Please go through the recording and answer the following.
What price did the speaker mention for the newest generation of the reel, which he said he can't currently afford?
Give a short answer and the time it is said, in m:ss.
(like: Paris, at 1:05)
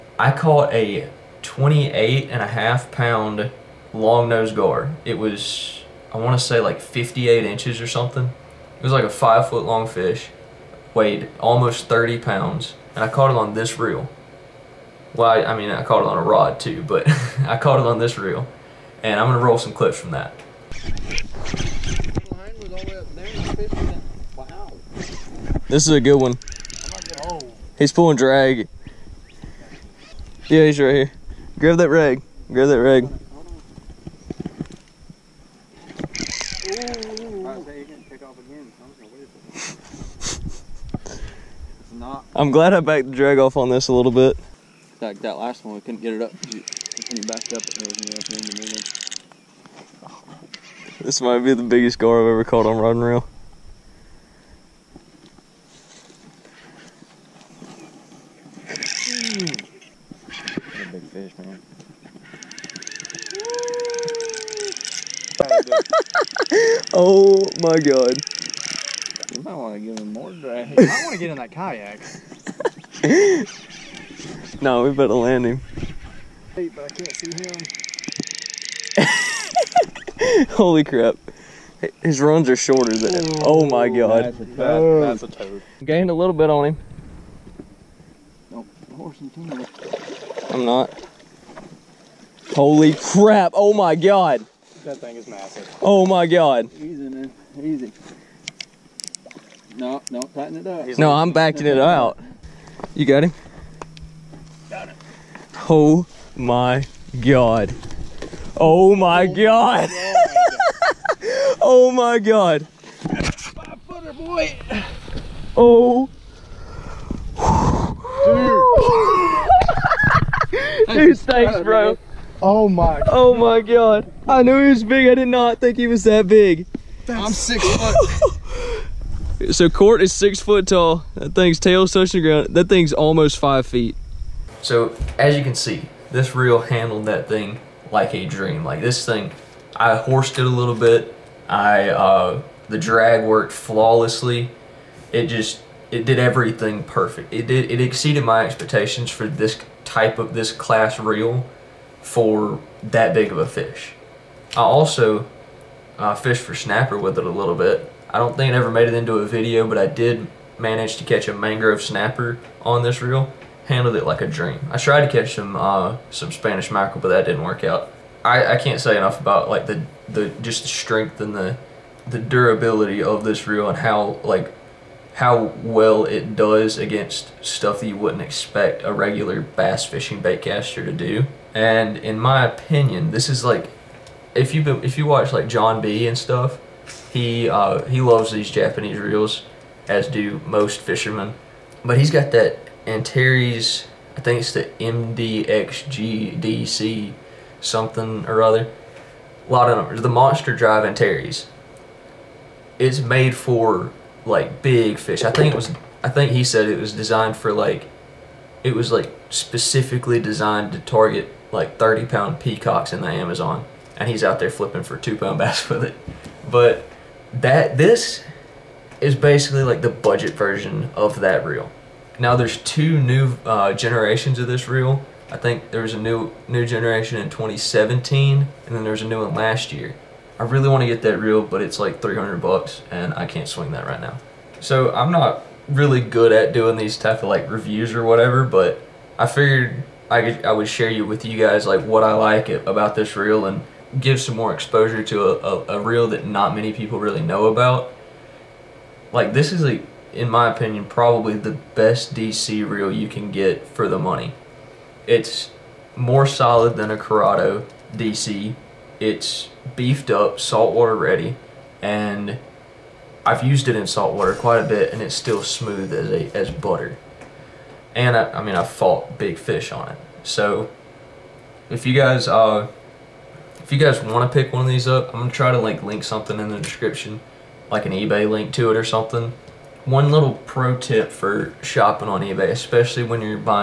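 $300, at 3:52.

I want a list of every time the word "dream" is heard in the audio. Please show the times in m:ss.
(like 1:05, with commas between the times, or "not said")
2:18, 2:44.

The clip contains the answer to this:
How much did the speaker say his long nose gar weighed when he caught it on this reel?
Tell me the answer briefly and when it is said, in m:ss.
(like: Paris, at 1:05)
28.5 pounds, at 0:01.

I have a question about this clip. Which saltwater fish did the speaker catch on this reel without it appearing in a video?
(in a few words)
mangrove snapper.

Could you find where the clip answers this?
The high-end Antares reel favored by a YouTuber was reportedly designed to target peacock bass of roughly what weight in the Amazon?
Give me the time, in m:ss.
3:31.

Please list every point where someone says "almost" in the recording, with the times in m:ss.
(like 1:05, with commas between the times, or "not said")
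0:11, 2:12.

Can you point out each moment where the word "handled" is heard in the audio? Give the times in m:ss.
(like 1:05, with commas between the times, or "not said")
2:16, 2:43.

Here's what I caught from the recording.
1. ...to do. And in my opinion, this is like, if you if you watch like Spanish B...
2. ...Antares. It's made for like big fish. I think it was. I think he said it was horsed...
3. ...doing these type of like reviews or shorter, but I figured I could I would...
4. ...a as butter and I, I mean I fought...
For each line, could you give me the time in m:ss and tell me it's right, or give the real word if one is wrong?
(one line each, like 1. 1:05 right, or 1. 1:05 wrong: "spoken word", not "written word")
1. 3:00 wrong: "John", not "Spanish"
2. 3:20 wrong: "designed", not "horsed"
3. 3:56 wrong: "whatever", not "shorter"
4. 4:26 right.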